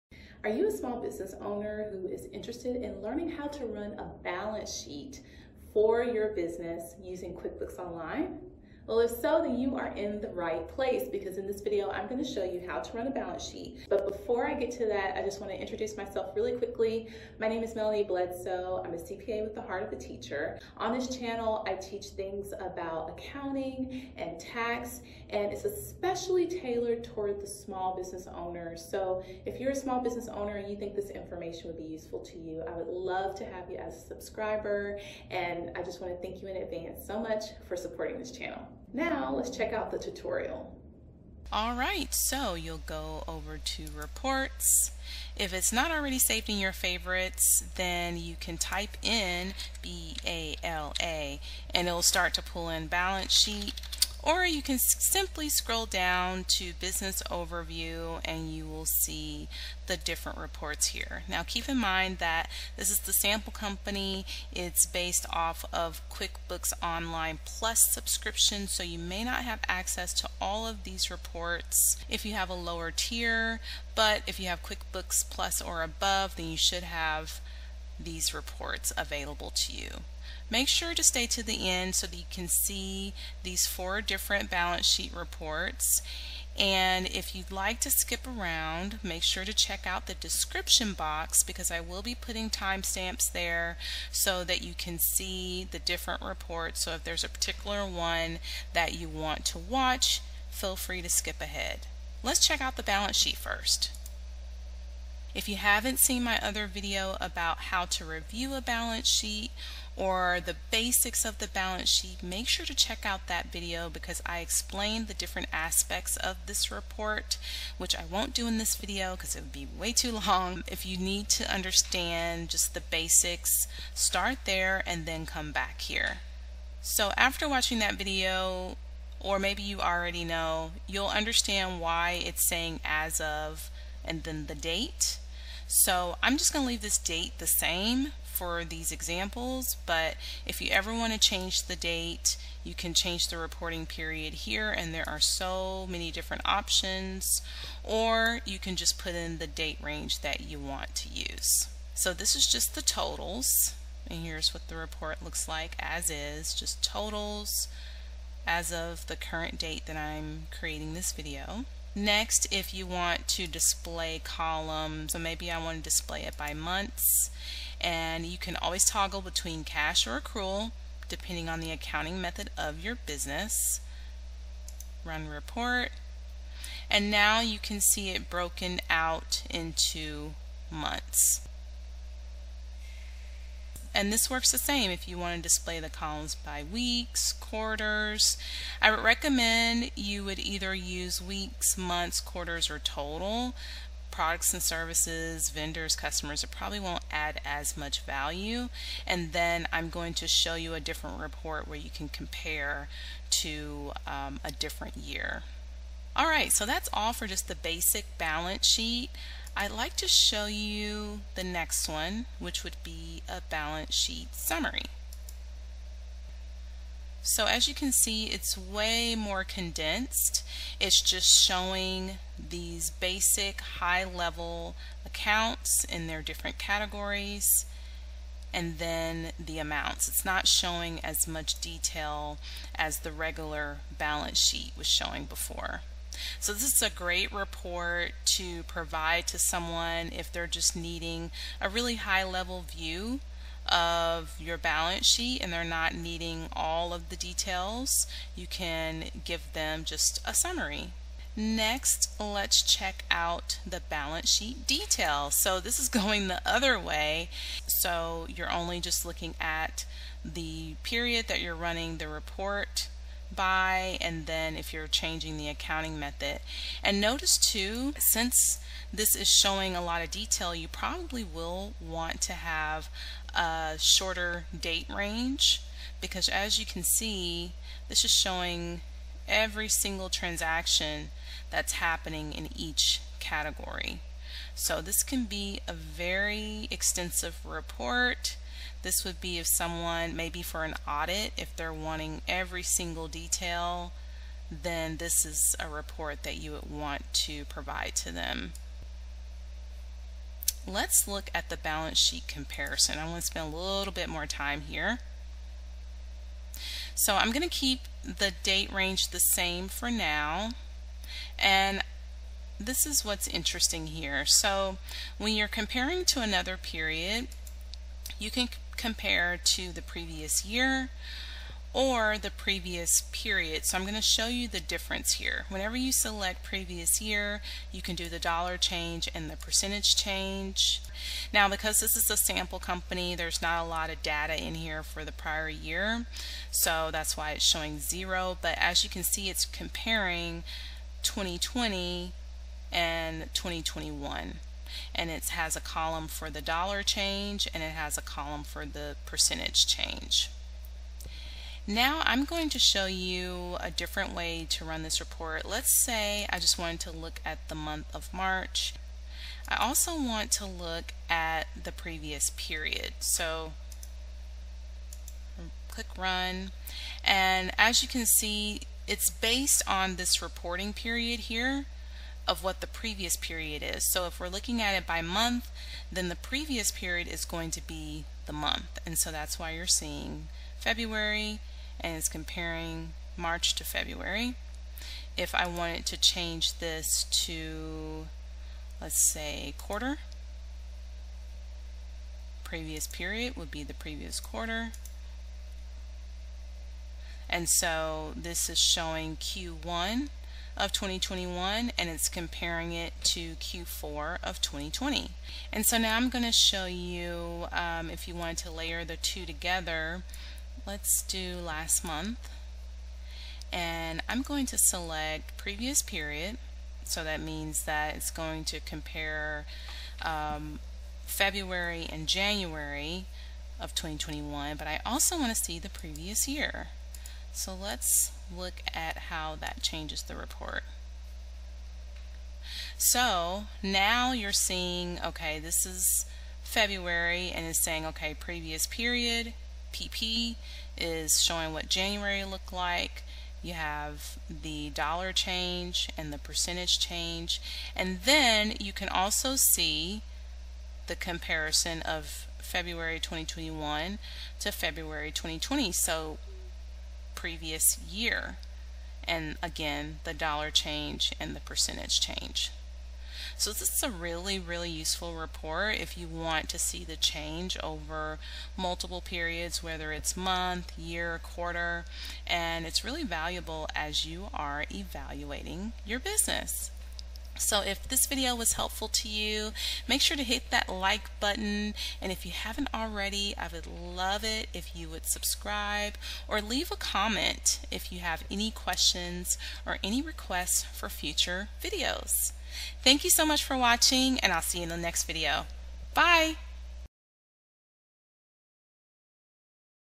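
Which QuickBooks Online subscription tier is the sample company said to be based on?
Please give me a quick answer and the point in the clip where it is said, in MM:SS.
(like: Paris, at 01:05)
QuickBooks Online Plus, at 01:06.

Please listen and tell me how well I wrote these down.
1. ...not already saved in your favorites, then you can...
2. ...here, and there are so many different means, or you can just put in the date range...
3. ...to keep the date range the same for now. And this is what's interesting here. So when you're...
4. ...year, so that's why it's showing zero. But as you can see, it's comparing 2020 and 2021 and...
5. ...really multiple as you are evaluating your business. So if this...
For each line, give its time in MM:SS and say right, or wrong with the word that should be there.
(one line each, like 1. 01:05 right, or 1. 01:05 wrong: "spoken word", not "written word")
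1. 00:45 right
2. 02:24 wrong: "options", not "means"
3. 05:07 right
4. 05:35 right
5. 07:52 wrong: "valuable", not "multiple".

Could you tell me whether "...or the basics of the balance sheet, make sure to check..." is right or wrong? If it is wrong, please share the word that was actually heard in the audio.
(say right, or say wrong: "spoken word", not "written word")
right.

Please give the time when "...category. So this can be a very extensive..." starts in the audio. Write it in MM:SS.
04:43.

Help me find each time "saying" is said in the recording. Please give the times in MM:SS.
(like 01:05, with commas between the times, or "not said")
02:12, 07:17.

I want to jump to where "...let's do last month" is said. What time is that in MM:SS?
06:50.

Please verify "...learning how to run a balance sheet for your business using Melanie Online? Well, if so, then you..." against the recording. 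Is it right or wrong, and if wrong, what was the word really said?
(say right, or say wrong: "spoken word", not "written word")
wrong: "QuickBooks", not "Melanie".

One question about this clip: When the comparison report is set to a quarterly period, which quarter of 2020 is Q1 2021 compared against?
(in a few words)
Q4.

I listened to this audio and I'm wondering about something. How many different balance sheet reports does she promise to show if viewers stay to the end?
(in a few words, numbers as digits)
4.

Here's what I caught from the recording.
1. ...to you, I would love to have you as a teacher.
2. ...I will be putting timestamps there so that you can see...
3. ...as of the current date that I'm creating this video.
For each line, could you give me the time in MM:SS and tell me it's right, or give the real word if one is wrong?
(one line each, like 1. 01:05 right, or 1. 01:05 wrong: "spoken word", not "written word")
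1. 00:32 wrong: "subscriber", not "teacher"
2. 01:31 right
3. 02:38 right.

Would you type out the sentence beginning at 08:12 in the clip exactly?
Thank you so much for watching and I'll see you in the next video.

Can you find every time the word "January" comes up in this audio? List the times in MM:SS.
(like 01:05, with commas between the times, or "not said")
07:02, 07:21.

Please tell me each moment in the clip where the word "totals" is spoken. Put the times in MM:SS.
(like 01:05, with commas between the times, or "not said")
02:32, 02:36, 03:12.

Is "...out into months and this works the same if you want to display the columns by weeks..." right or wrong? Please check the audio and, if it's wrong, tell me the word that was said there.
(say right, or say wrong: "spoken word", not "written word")
right.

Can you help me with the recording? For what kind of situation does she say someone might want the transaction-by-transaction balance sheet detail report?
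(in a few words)
An audit.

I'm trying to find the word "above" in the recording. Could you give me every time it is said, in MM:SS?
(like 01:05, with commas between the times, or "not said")
01:15.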